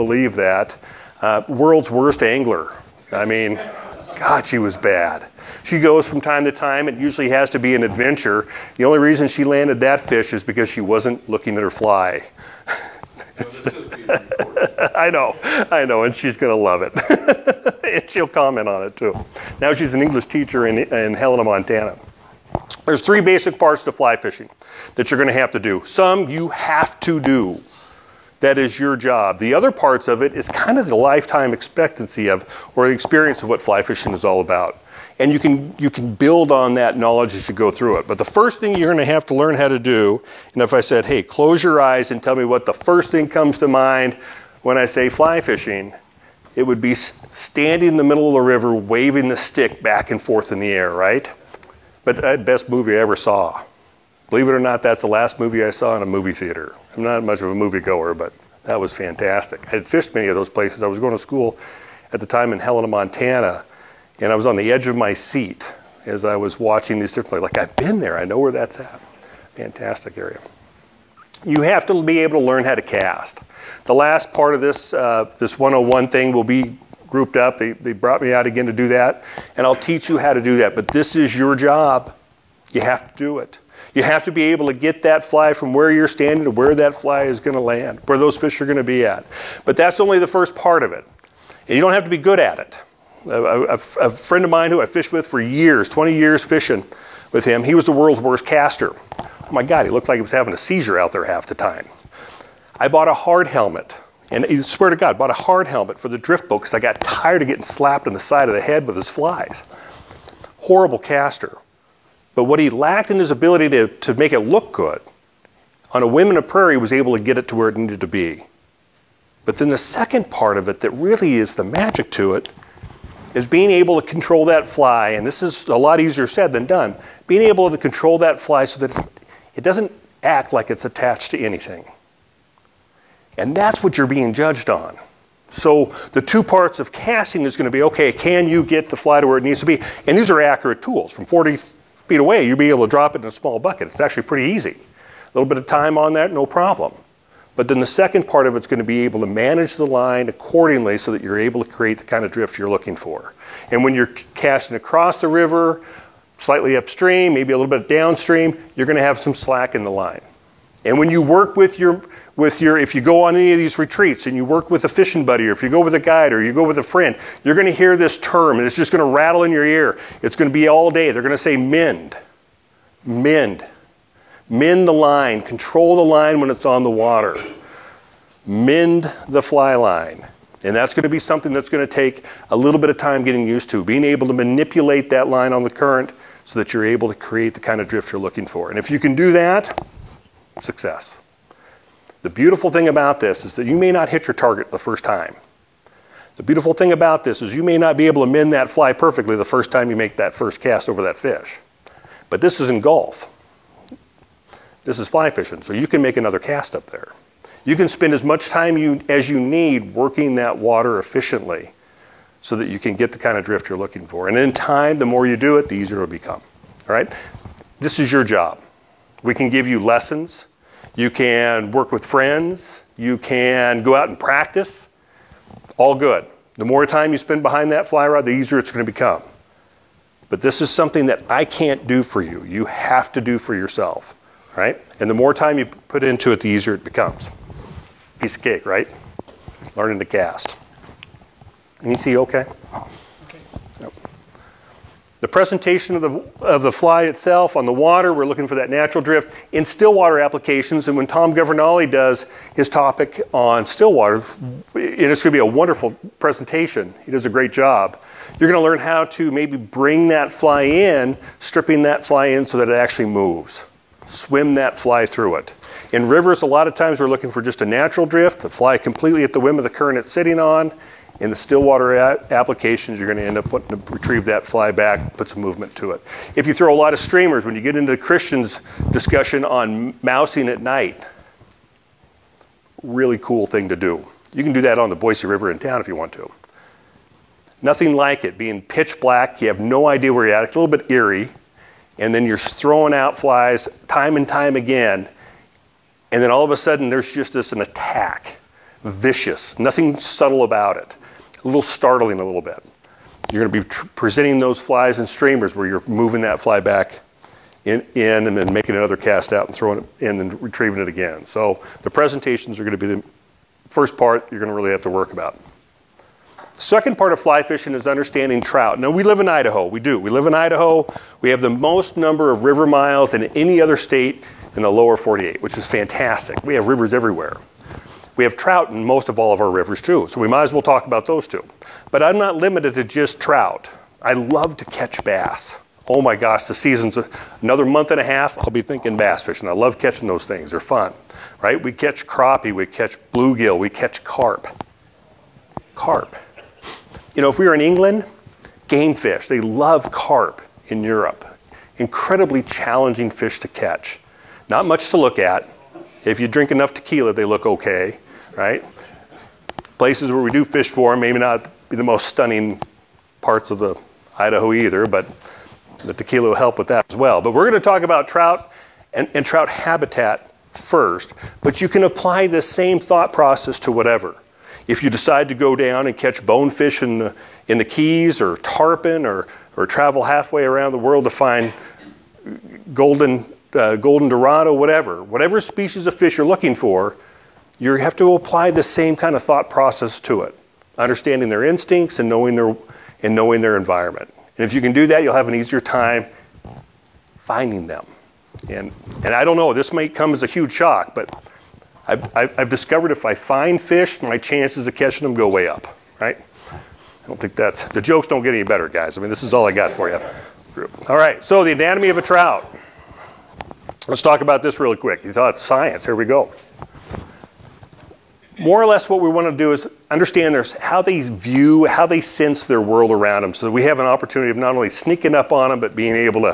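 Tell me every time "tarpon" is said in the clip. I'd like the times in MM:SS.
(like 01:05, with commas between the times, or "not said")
06:18.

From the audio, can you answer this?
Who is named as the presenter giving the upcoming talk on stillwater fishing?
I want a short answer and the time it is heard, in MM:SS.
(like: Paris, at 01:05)
Tom Governale, at 04:11.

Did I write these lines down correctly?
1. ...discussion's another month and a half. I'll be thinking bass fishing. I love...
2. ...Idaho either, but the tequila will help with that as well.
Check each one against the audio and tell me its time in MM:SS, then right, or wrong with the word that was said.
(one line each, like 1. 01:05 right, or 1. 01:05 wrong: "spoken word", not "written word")
1. 05:36 wrong: "season", not "discussion"
2. 06:04 right.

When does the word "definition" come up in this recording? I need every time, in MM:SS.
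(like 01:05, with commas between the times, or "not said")
not said.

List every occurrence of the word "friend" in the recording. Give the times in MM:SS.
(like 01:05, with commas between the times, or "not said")
01:34, 02:46, 03:42.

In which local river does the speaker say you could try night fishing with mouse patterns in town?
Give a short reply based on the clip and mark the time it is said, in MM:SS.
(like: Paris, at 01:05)
Boise River, at 04:44.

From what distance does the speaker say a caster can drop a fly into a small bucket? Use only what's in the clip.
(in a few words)
40 feet.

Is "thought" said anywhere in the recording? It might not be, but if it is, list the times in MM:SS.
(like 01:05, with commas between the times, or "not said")
06:12, 06:29, 06:55.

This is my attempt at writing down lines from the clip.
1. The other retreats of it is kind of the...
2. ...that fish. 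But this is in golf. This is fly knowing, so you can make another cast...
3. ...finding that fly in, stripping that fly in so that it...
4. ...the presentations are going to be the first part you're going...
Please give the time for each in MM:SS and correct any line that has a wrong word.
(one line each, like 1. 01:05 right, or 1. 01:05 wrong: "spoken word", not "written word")
1. 00:29 wrong: "parts", not "retreats"
2. 03:21 wrong: "fishing", not "knowing"
3. 04:19 wrong: "bring", not "finding"
4. 05:11 right.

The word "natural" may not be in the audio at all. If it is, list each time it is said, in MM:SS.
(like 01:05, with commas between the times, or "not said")
04:08, 04:27.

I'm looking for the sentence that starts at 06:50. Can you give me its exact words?
All right, so the anatomy of a trout.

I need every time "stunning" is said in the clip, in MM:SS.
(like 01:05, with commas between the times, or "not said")
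06:02.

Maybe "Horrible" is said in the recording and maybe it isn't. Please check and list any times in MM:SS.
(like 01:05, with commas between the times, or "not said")
01:50.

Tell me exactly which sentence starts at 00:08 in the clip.
The only reason she landed that fish is because she wasn't looking at her fly.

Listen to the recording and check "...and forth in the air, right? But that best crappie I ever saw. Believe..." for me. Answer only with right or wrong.
wrong.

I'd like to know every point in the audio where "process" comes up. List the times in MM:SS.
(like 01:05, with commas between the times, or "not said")
06:13, 06:29.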